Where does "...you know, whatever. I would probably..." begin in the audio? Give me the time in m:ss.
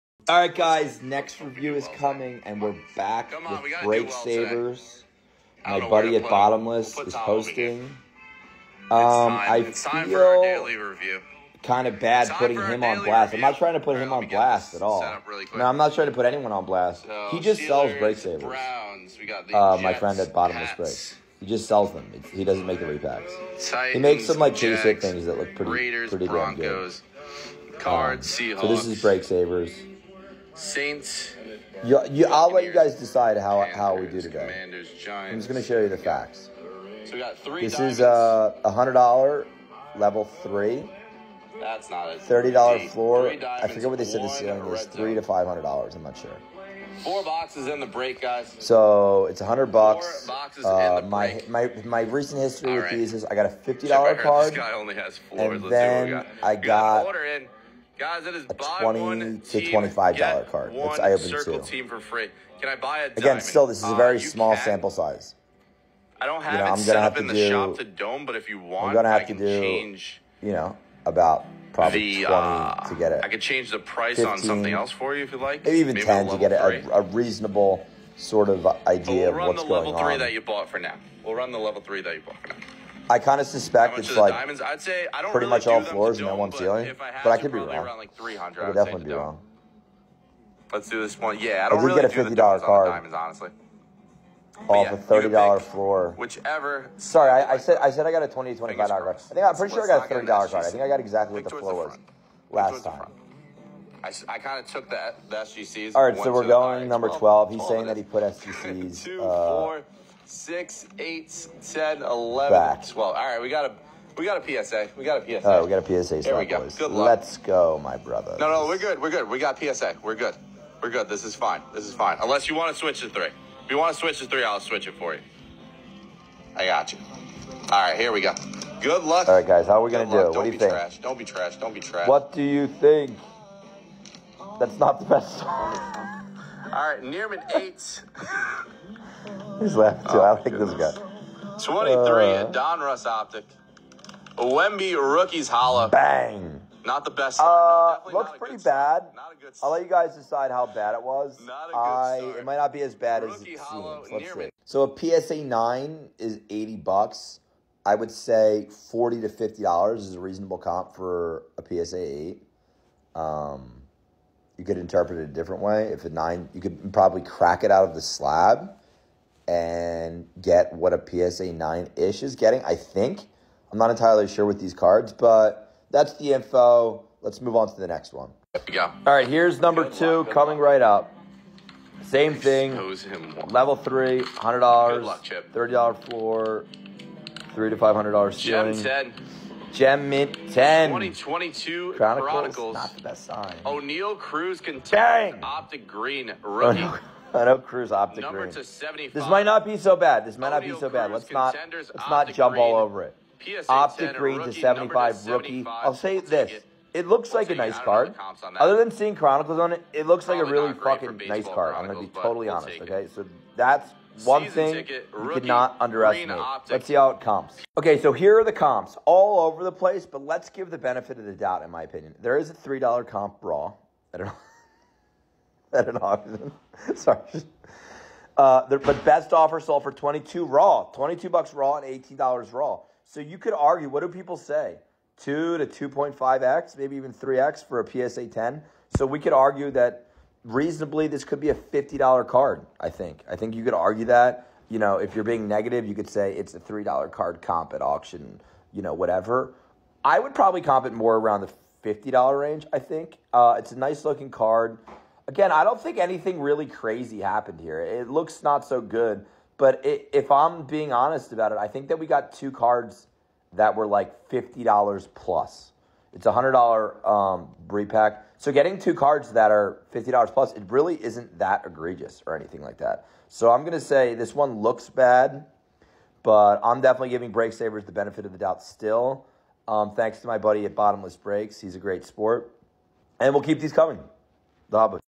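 4:08.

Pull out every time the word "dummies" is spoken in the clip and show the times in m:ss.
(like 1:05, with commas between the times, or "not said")
not said.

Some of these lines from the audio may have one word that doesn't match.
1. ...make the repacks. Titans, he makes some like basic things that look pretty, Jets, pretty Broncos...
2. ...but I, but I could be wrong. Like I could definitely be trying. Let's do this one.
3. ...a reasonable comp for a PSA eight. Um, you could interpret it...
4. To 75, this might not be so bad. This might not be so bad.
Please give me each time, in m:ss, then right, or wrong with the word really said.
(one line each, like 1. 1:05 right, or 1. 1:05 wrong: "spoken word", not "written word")
1. 0:22 wrong: "Raiders", not "Jets"
2. 1:26 wrong: "wrong", not "trying"
3. 2:40 right
4. 3:18 right.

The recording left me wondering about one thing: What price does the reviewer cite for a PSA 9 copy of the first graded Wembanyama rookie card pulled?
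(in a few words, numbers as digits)
$80.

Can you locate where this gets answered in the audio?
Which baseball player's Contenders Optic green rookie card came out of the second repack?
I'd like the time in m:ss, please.
3:13.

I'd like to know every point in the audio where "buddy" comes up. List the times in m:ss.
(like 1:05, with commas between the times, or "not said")
0:05, 4:40.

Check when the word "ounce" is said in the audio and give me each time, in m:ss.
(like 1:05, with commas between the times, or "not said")
not said.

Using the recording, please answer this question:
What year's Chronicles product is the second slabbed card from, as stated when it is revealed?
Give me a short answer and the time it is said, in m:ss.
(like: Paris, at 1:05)
2022, at 3:10.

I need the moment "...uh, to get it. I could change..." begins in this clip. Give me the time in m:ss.
1:12.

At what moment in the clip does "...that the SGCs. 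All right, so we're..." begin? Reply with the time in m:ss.
1:44.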